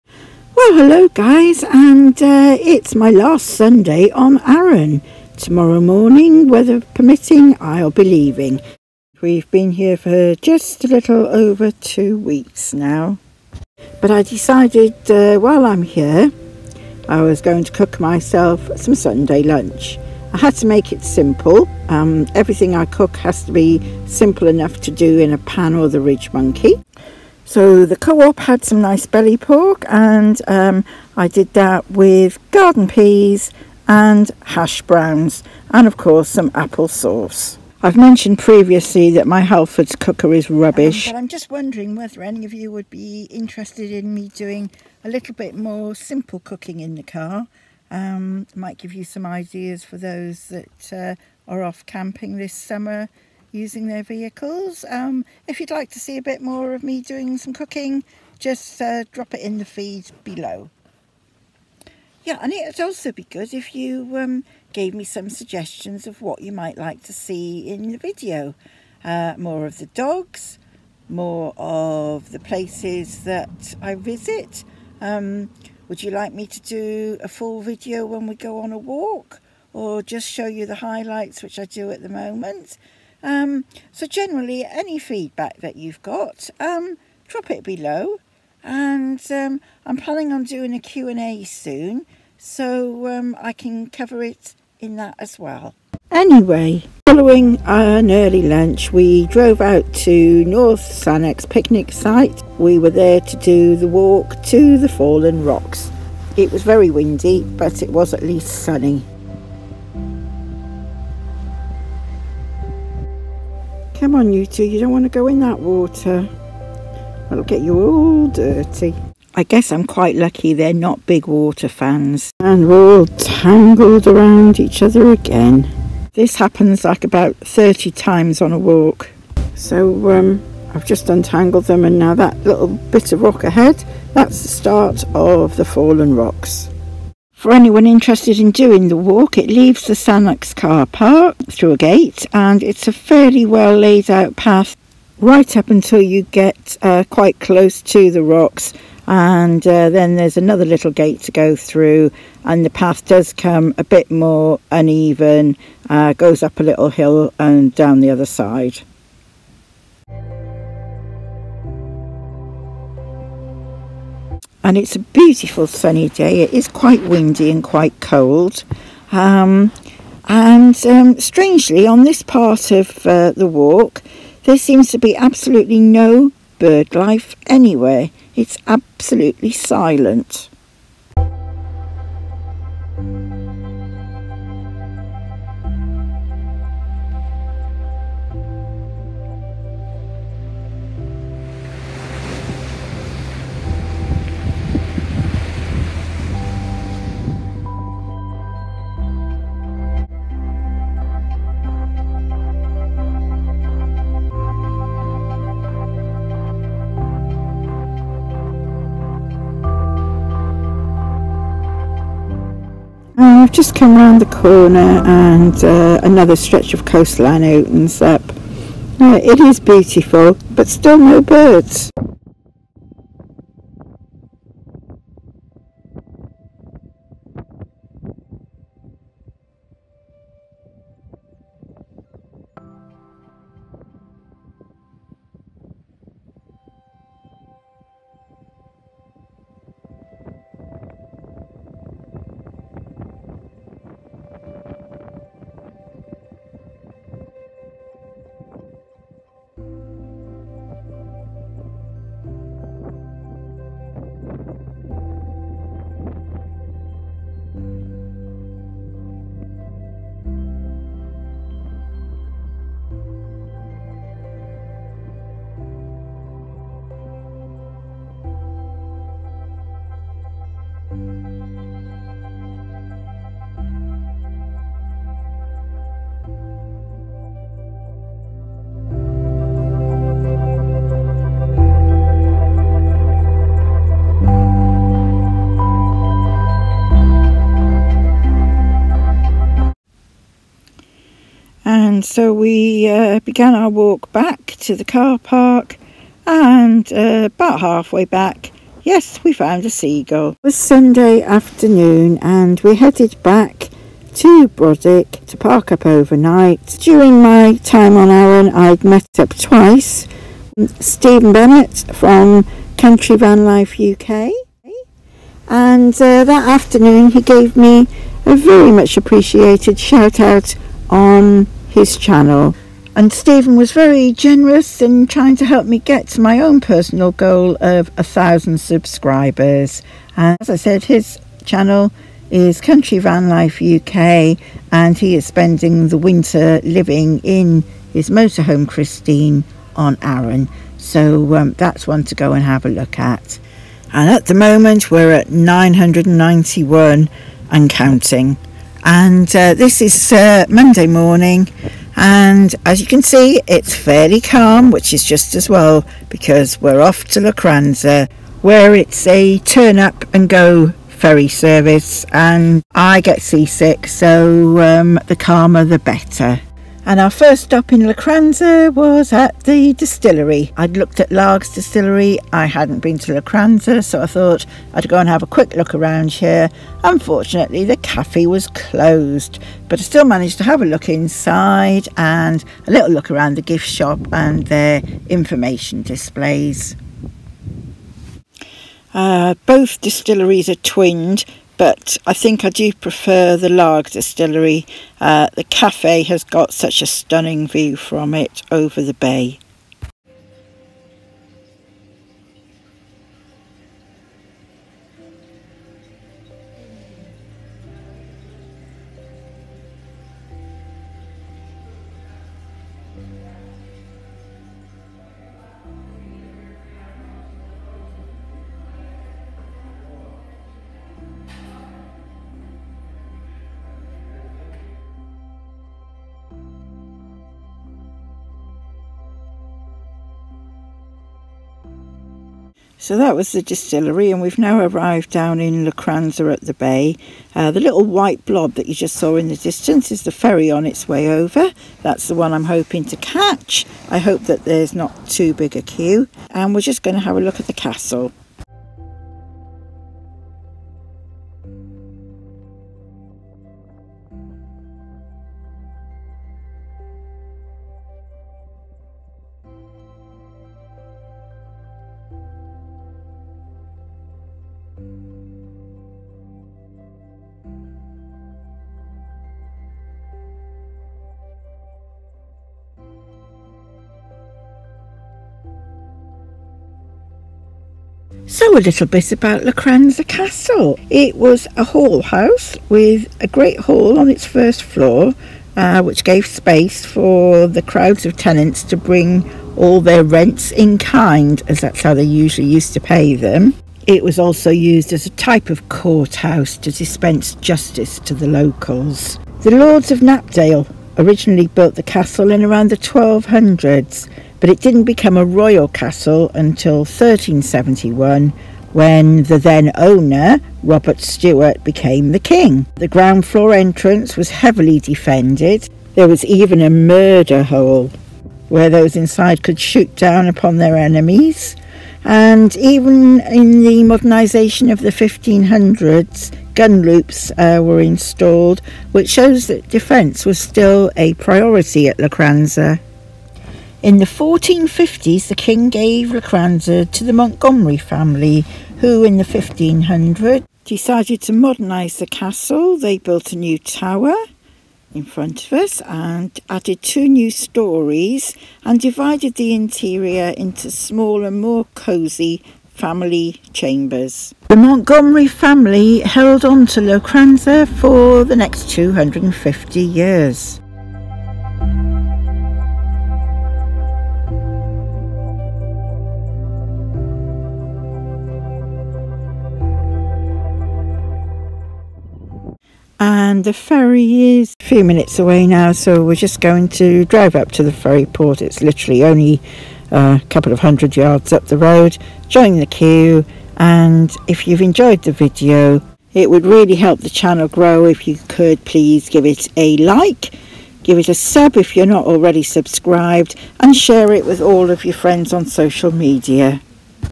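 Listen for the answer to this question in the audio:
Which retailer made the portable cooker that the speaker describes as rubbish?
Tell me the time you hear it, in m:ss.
0:39.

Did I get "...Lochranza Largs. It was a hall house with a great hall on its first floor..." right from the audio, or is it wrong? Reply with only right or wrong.
wrong.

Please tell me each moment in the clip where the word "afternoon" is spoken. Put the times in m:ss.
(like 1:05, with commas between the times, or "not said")
5:01, 5:16.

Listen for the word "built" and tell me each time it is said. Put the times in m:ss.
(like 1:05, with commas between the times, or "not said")
8:21, 9:02.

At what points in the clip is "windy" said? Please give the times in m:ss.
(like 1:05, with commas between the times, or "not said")
1:46, 2:47.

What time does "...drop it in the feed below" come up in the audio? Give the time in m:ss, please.
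0:59.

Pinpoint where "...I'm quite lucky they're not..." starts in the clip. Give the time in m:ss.
1:59.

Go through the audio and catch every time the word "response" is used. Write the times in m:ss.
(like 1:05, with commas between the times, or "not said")
not said.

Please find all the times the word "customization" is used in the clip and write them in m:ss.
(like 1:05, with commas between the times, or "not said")
not said.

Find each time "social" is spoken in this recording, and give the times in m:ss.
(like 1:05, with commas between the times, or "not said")
9:55.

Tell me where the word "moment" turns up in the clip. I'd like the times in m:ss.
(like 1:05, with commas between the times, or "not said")
1:22, 5:44.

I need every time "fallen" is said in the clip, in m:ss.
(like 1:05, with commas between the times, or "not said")
1:44, 2:15.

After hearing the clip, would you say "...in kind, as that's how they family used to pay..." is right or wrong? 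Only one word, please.
wrong.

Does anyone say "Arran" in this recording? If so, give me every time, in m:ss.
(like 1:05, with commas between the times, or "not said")
0:04, 5:08, 5:40.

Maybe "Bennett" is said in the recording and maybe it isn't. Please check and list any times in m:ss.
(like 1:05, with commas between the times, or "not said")
5:11.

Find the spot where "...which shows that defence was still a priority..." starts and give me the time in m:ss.
8:48.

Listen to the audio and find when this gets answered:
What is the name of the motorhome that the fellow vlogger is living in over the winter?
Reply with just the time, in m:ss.
5:38.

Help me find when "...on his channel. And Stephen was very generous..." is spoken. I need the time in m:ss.
5:20.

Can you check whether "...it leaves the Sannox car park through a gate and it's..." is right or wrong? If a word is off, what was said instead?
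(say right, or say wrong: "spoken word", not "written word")
right.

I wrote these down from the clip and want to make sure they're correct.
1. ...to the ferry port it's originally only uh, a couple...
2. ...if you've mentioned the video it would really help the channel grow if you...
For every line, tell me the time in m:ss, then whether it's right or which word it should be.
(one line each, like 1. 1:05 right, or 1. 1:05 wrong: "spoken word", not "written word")
1. 9:37 wrong: "literally", not "originally"
2. 9:44 wrong: "enjoyed", not "mentioned".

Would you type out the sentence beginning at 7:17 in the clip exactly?
Uh, the little white blob that you just saw in the distance is the ferry on its way over.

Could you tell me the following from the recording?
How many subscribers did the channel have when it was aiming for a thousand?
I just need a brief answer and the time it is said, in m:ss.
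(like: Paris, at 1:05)
991, at 5:45.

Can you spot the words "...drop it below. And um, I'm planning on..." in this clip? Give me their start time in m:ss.
1:27.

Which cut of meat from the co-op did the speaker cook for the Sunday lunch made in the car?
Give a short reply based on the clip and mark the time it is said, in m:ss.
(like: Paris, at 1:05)
Belly pork, at 0:29.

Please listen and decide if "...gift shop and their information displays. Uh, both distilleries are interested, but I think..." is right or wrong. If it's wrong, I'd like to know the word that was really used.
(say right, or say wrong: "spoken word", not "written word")
wrong: "twinned", not "interested".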